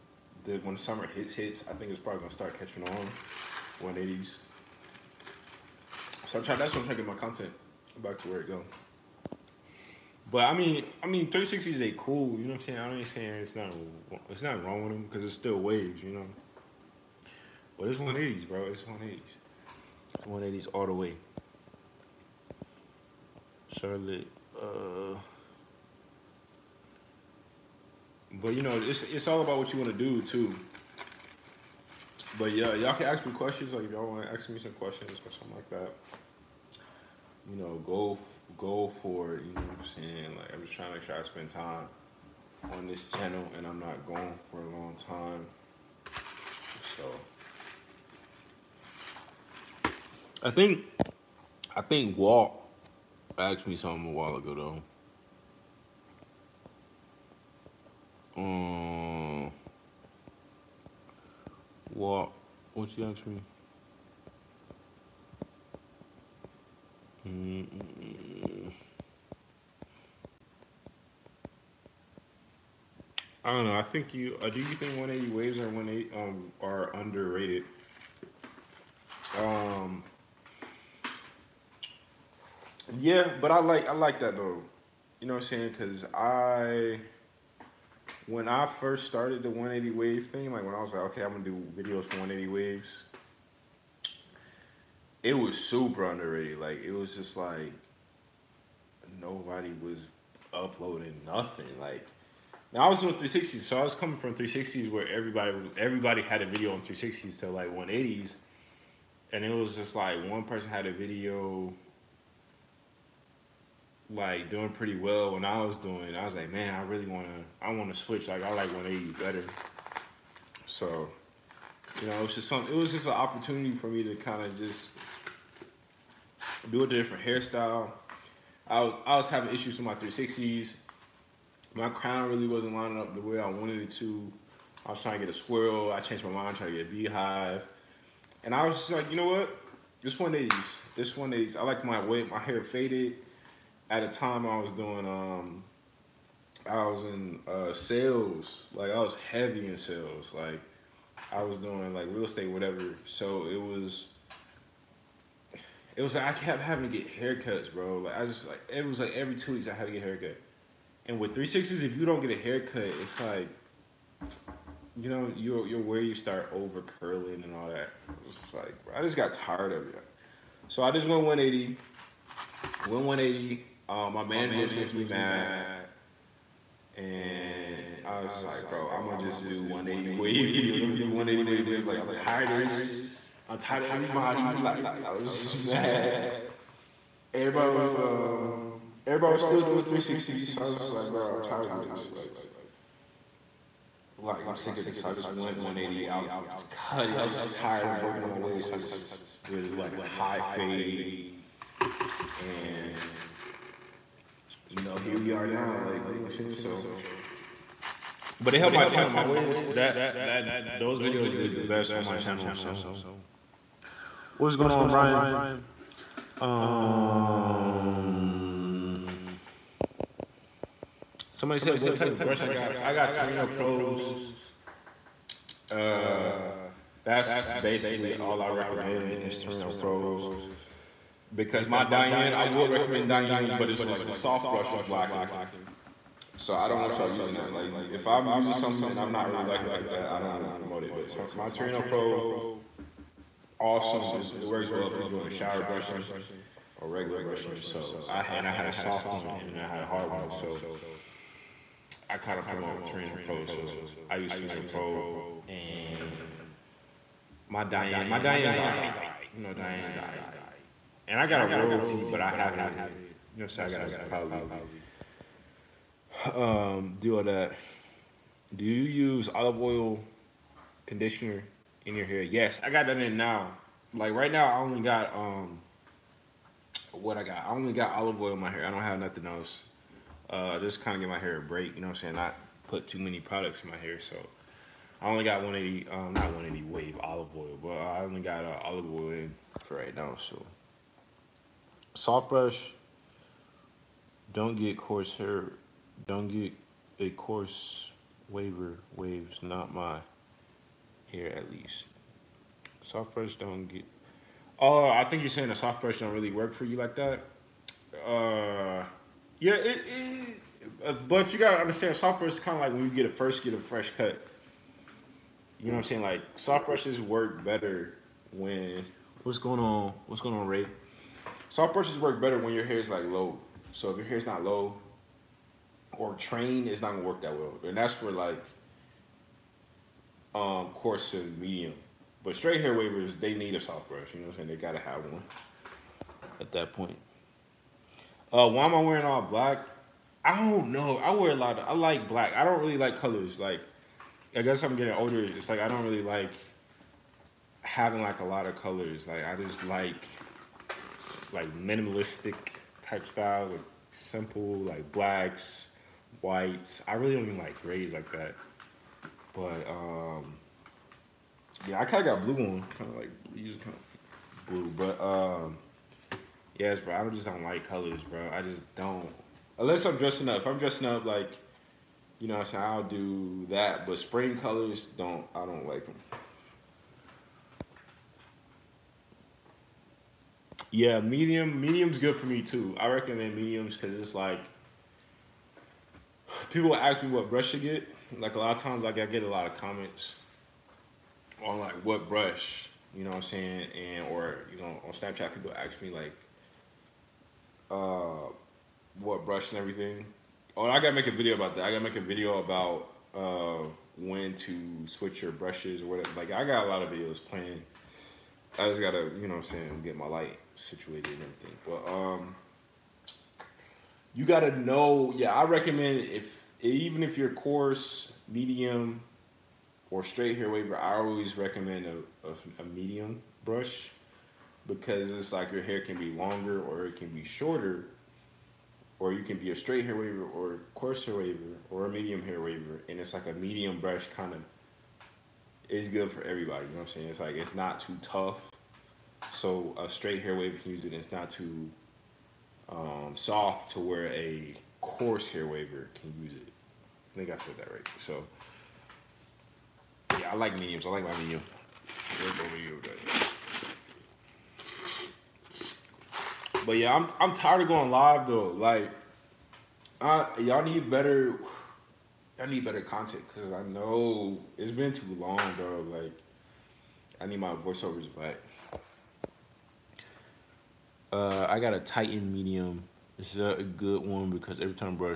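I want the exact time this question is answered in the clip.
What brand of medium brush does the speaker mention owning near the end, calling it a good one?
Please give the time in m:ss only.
7:51.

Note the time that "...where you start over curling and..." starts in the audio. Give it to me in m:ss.
2:45.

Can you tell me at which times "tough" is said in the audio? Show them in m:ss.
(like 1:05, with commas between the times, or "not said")
7:18.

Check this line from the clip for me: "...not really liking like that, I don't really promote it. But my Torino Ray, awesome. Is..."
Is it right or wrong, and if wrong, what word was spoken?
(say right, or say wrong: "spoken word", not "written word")
wrong: "Pro", not "Ray".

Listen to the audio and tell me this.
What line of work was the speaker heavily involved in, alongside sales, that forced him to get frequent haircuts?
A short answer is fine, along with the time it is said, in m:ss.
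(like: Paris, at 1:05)
real estate, at 2:32.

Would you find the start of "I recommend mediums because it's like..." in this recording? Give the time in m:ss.
6:22.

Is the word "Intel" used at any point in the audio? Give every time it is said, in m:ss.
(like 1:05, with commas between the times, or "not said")
not said.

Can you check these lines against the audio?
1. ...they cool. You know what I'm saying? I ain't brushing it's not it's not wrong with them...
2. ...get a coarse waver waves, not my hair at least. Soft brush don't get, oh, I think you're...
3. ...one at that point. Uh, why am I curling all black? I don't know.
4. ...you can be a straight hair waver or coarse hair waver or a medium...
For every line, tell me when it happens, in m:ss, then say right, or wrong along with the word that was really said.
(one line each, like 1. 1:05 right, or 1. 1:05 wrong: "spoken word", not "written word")
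1. 0:11 wrong: "saying", not "brushing"
2. 4:56 right
3. 5:35 wrong: "wearing", not "curling"
4. 7:09 right.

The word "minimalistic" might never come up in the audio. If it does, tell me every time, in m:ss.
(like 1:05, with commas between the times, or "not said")
5:51.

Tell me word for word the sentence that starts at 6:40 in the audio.
Oh, and I gotta make a video about that.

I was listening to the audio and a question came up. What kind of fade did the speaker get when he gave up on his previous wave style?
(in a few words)
high fade.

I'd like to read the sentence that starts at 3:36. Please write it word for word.
Um Somebody said what type of brush I got.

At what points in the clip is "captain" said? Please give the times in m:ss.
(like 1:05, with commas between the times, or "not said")
not said.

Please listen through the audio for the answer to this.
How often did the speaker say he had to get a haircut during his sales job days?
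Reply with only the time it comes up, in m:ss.
2:39.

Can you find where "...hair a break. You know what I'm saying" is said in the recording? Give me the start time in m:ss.
4:41.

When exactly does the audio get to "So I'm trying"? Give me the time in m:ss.
0:06.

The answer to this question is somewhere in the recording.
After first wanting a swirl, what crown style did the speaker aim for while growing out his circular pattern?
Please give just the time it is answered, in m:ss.
2:16.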